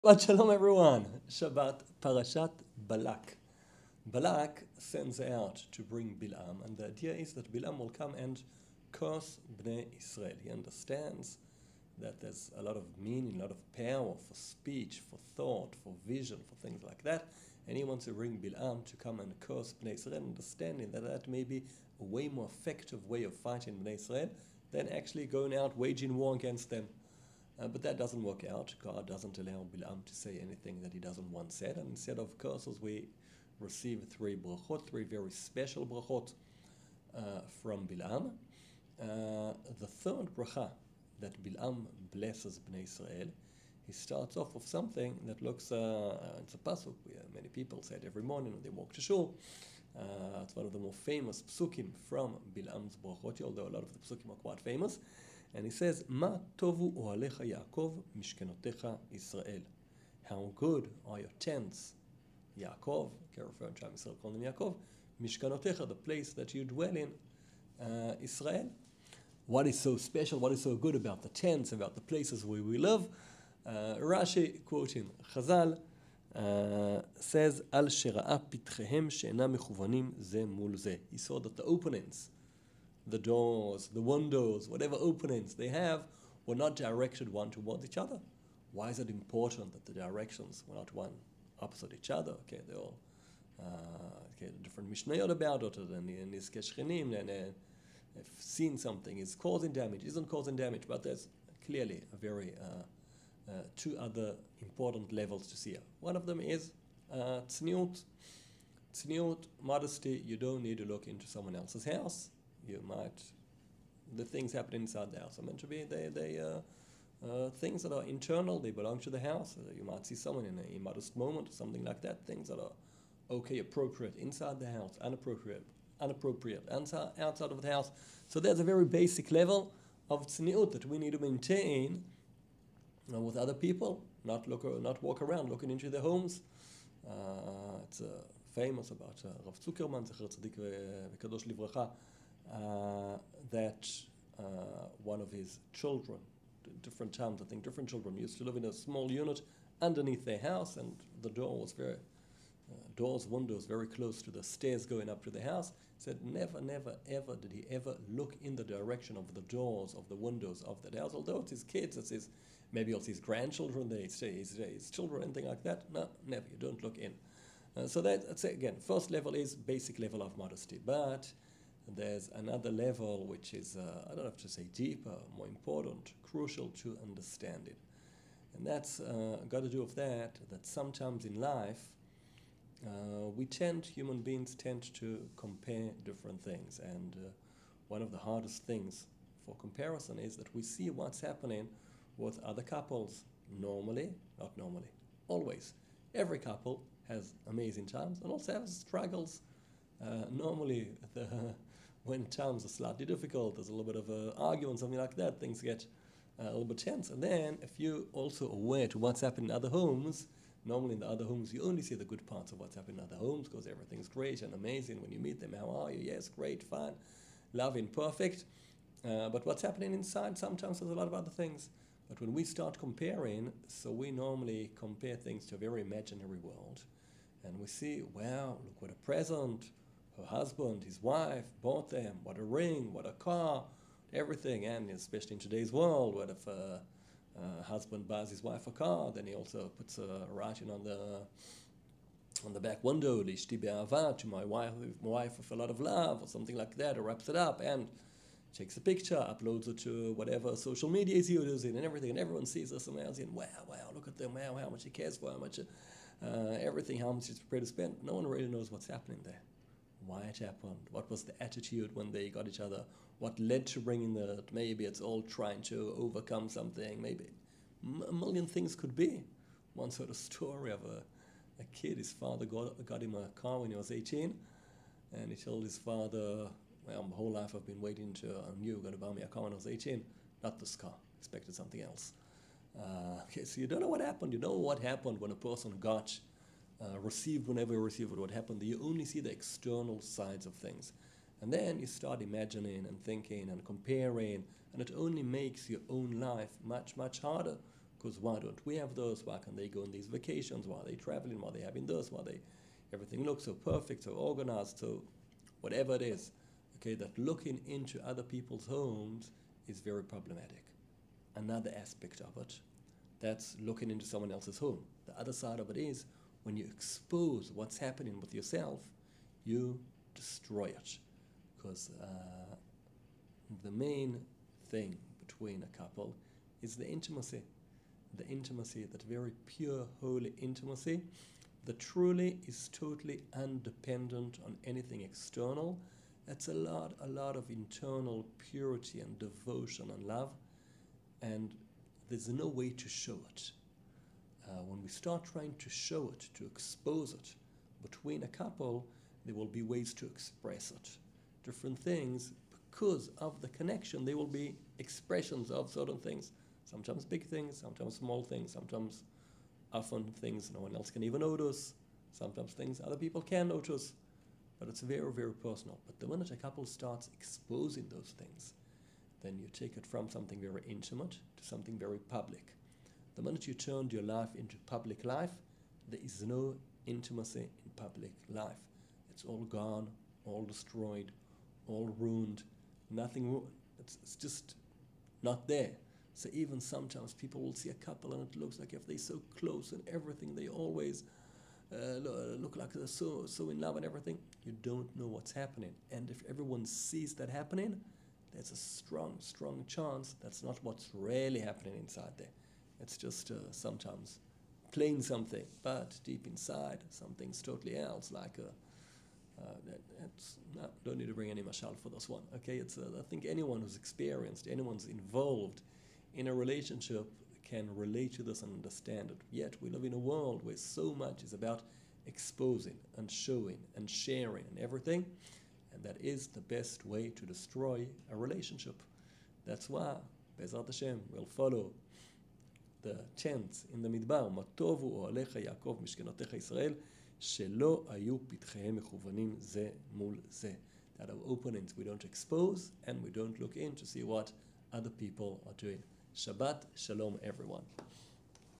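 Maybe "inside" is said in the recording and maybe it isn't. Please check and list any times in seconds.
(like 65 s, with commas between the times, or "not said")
114 s, 124 s, 219 s, 401 s, 406 s.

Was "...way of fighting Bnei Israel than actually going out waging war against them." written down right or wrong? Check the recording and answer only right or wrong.
right.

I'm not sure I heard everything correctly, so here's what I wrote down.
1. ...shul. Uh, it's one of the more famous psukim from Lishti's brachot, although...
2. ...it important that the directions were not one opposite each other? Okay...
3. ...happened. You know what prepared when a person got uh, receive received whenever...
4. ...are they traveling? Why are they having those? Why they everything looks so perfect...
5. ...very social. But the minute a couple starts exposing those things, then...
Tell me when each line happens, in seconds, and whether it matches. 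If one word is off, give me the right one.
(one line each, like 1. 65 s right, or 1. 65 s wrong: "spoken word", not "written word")
1. 49 s wrong: "Bilam", not "Lishti"
2. 88 s right
3. 284 s wrong: "happened", not "prepared"
4. 300 s right
5. 365 s wrong: "personal", not "social".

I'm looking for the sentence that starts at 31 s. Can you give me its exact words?
And instead of curses, we receive three brachot, three very special brachot uh, from Bilam.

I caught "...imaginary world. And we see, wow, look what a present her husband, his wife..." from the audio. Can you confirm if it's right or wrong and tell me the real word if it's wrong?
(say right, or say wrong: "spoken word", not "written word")
right.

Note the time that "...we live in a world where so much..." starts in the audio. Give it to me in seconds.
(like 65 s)
419 s.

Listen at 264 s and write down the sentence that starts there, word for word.
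Maybe it's all trying to overcome something.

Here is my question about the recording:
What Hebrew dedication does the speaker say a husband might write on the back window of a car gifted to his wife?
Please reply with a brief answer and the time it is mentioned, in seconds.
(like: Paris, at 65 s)
Lishti Be'ava, at 243 s.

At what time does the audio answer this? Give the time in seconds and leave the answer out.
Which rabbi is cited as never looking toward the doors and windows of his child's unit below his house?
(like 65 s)
139 s.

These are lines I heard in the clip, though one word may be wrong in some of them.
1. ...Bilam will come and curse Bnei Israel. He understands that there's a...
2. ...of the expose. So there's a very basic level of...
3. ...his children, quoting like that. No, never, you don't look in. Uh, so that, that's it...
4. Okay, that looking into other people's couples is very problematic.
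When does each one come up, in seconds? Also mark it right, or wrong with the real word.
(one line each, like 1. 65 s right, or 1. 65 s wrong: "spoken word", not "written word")
1. 7 s right
2. 127 s wrong: "house", not "expose"
3. 164 s wrong: "anything", not "quoting"
4. 306 s wrong: "homes", not "couples".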